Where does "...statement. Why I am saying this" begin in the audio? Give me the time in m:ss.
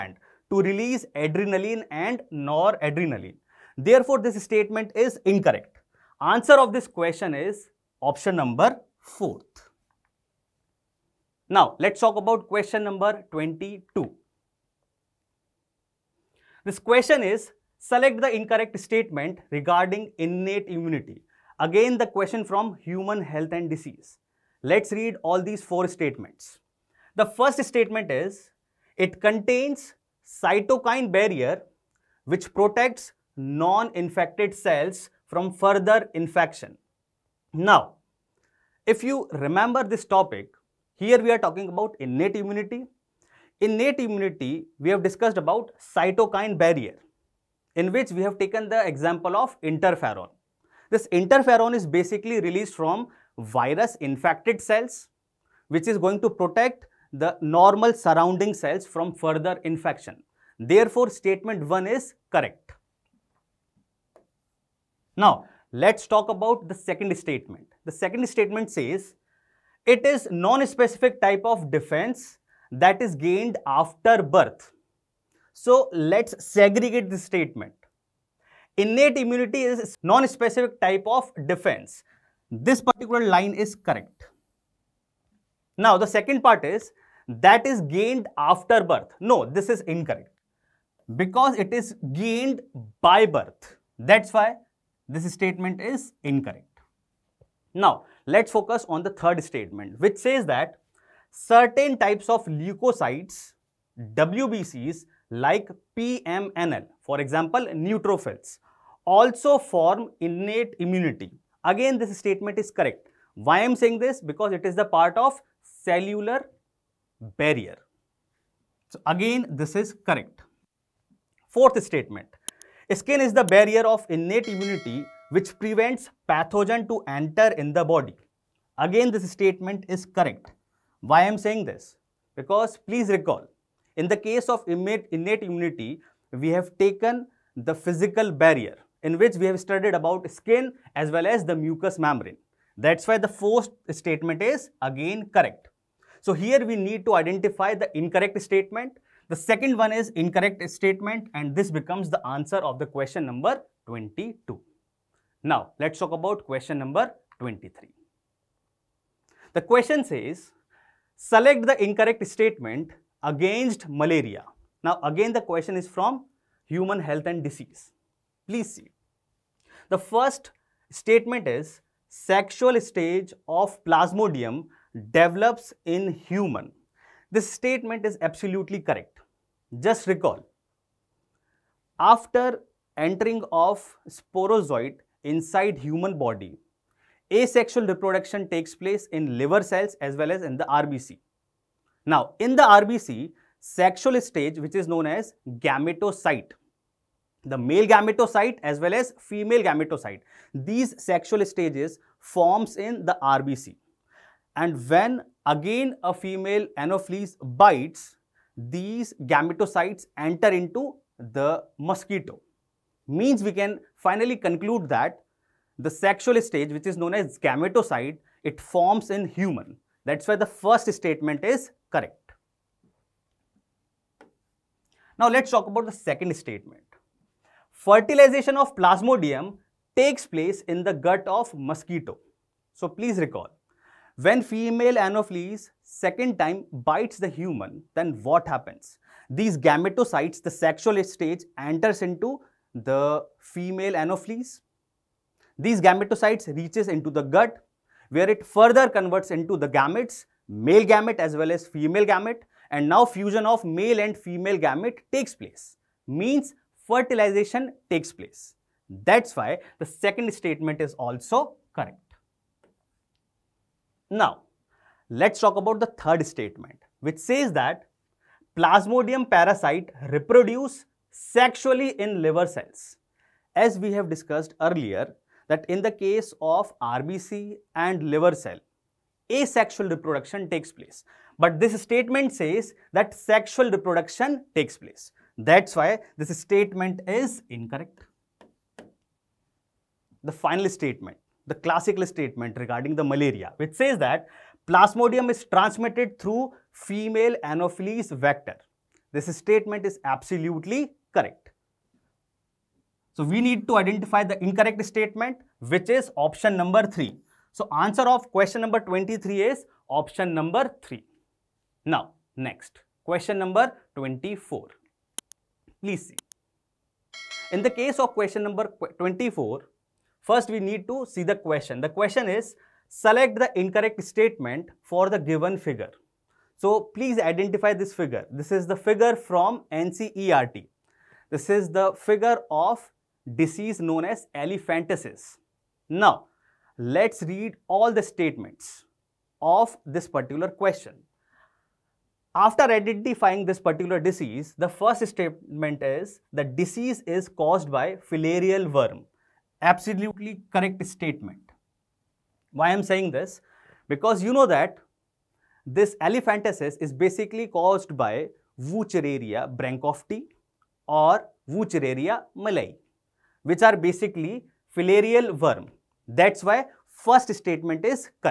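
5:50.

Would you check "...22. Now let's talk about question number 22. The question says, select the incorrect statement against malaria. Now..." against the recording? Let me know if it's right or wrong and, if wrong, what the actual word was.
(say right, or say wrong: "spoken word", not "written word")
wrong: "23", not "22".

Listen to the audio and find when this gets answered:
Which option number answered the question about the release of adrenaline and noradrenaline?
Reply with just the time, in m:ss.
0:08.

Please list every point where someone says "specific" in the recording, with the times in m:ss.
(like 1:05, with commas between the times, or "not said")
1:10, 1:20.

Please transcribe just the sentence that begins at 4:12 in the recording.
And now fusion of male and female gamete takes place.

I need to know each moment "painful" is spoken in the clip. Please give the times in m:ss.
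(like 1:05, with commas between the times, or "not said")
not said.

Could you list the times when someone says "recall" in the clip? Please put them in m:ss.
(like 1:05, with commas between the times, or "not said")
2:13, 3:00, 3:53.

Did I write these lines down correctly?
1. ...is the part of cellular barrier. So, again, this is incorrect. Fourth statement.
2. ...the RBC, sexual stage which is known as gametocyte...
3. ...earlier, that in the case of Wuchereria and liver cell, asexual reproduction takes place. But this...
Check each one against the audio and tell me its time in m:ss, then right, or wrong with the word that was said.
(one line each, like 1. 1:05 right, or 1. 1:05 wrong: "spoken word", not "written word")
1. 1:54 wrong: "correct", not "incorrect"
2. 3:12 right
3. 4:34 wrong: "RBC", not "Wuchereria".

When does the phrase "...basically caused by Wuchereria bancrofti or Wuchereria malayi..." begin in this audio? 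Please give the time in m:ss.
5:56.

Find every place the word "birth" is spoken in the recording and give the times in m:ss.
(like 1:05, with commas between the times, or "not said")
1:14, 1:28, 1:33.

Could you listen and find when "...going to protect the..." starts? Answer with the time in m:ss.
0:55.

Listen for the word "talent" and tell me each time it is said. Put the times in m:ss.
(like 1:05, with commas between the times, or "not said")
not said.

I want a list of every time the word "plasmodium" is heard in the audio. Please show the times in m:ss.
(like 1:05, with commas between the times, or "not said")
2:53, 3:48, 4:28, 4:54.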